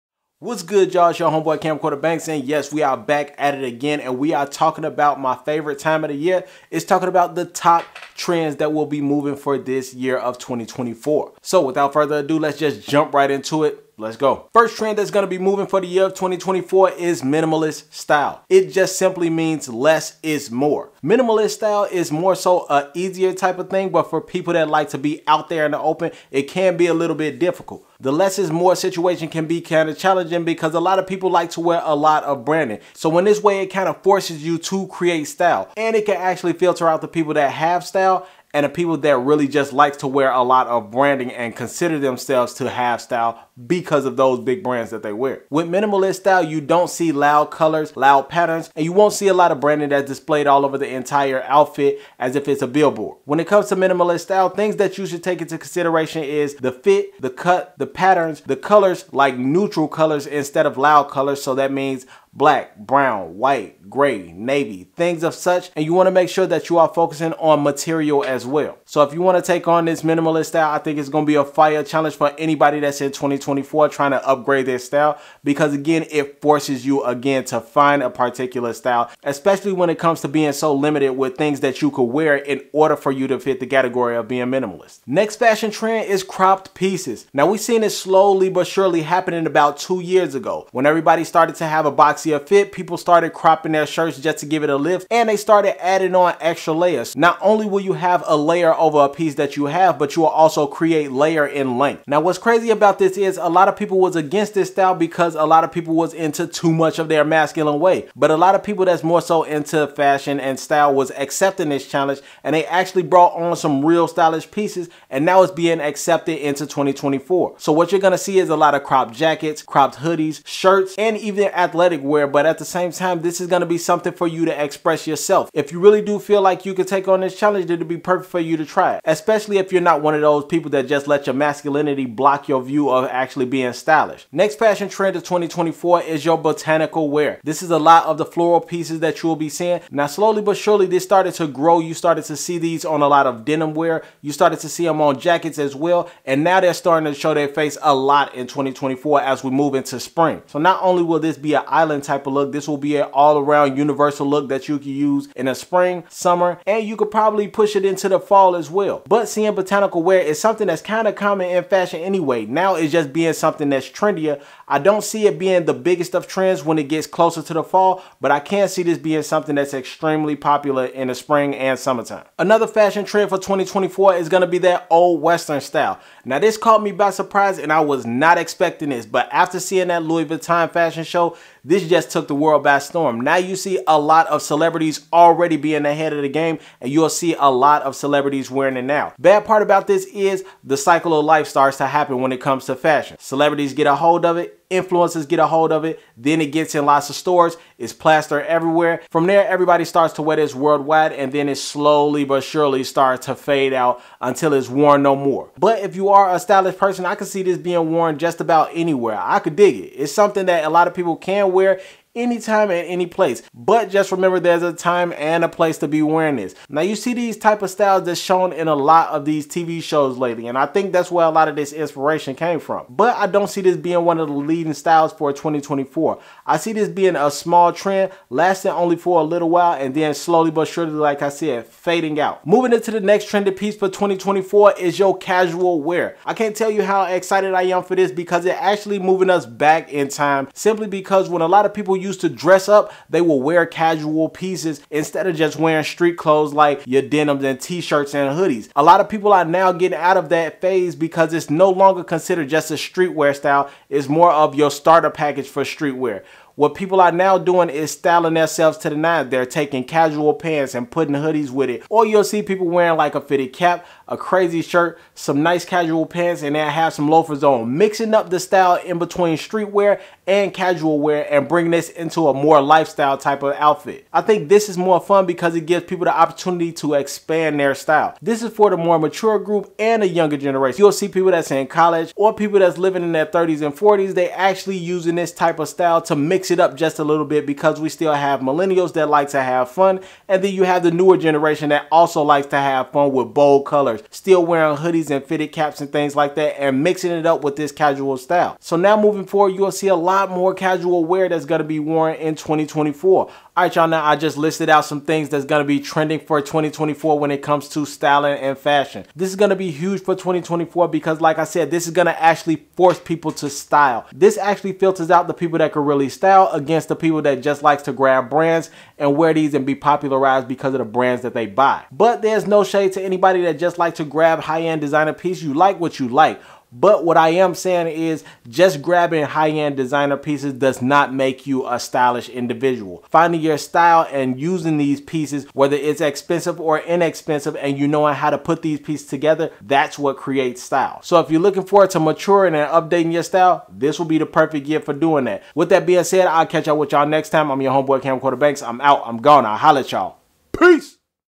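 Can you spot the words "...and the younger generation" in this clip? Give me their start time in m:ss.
4:39.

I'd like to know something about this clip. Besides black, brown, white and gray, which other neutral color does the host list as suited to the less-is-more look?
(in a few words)
navy.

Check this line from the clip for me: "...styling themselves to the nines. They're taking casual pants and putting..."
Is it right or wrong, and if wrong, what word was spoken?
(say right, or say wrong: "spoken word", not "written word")
right.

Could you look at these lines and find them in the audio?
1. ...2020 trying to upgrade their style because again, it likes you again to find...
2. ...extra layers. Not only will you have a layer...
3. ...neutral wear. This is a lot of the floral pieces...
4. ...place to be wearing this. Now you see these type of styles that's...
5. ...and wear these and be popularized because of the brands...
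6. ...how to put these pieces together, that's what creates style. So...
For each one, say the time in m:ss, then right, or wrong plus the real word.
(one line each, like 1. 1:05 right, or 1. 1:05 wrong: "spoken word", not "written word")
1. 1:13 wrong: "forces", not "likes"
2. 1:36 right
3. 2:16 wrong: "botanical", not "neutral"
4. 3:35 right
5. 5:18 right
6. 5:38 right.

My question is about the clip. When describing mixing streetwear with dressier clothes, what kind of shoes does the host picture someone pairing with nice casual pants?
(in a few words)
loafers.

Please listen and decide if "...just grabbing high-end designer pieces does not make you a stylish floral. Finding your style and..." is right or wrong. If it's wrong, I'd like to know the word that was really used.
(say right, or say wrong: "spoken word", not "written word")
wrong: "individual", not "floral".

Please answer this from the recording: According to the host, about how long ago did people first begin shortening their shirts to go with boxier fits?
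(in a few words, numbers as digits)
2 years ago.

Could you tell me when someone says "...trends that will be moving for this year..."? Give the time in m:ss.
0:08.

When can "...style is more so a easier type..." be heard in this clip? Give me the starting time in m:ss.
0:21.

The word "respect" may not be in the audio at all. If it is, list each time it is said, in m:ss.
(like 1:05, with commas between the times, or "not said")
not said.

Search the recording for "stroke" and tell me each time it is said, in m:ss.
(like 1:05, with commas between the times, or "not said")
not said.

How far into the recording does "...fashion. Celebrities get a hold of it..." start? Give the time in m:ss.
3:13.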